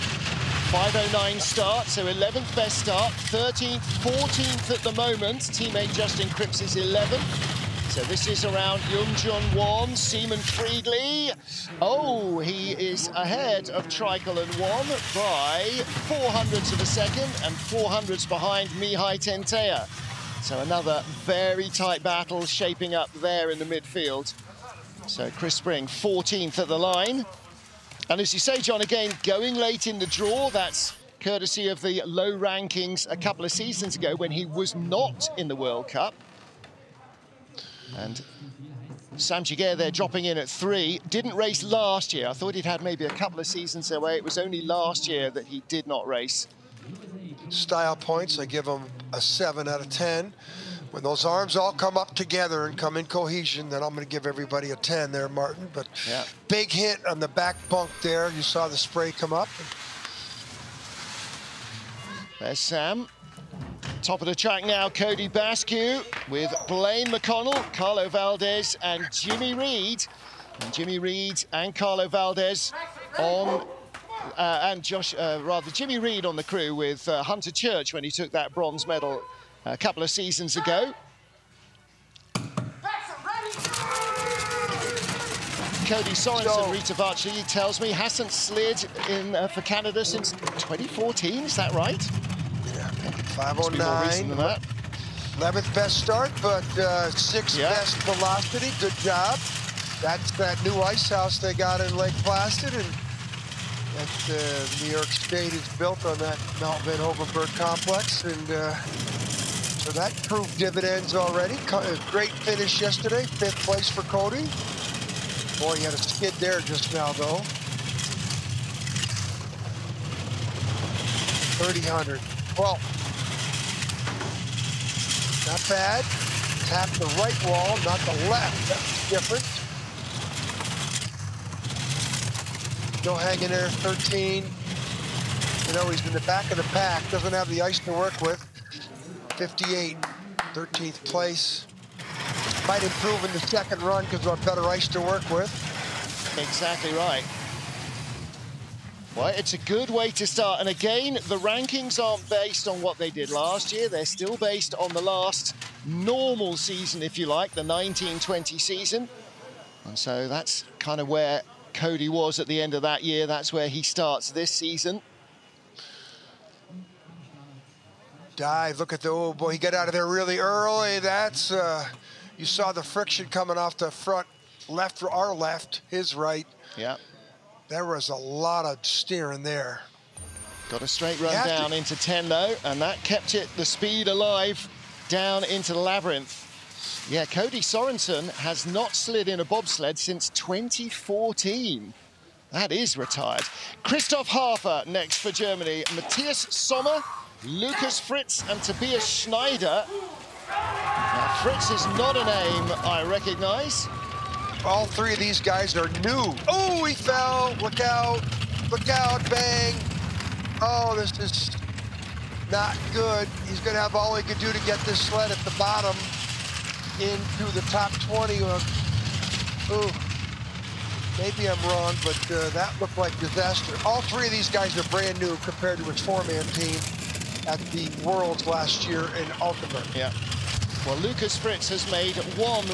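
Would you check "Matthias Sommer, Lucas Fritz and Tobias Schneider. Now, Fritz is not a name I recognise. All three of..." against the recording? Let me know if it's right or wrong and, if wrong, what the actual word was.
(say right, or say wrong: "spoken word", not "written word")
right.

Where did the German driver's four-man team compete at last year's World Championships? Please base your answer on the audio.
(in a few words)
Altenberg.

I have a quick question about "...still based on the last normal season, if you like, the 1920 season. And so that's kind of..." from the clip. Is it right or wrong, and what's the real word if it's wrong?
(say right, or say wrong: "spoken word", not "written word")
right.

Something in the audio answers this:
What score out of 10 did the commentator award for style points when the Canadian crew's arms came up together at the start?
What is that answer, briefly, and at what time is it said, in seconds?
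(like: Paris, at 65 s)
7, at 49 s.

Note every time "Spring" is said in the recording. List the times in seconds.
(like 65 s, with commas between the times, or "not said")
25 s.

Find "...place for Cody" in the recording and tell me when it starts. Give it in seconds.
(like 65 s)
113 s.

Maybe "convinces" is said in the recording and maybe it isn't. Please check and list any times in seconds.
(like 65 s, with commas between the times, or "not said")
not said.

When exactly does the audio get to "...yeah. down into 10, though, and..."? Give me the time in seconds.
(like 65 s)
181 s.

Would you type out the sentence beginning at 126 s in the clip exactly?
Tap the right wall, not the left.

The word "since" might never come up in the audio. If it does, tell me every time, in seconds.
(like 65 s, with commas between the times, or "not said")
90 s, 189 s.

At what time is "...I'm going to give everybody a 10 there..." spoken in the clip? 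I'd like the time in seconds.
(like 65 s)
53 s.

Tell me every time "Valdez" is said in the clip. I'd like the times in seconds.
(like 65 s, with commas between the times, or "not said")
68 s, 72 s.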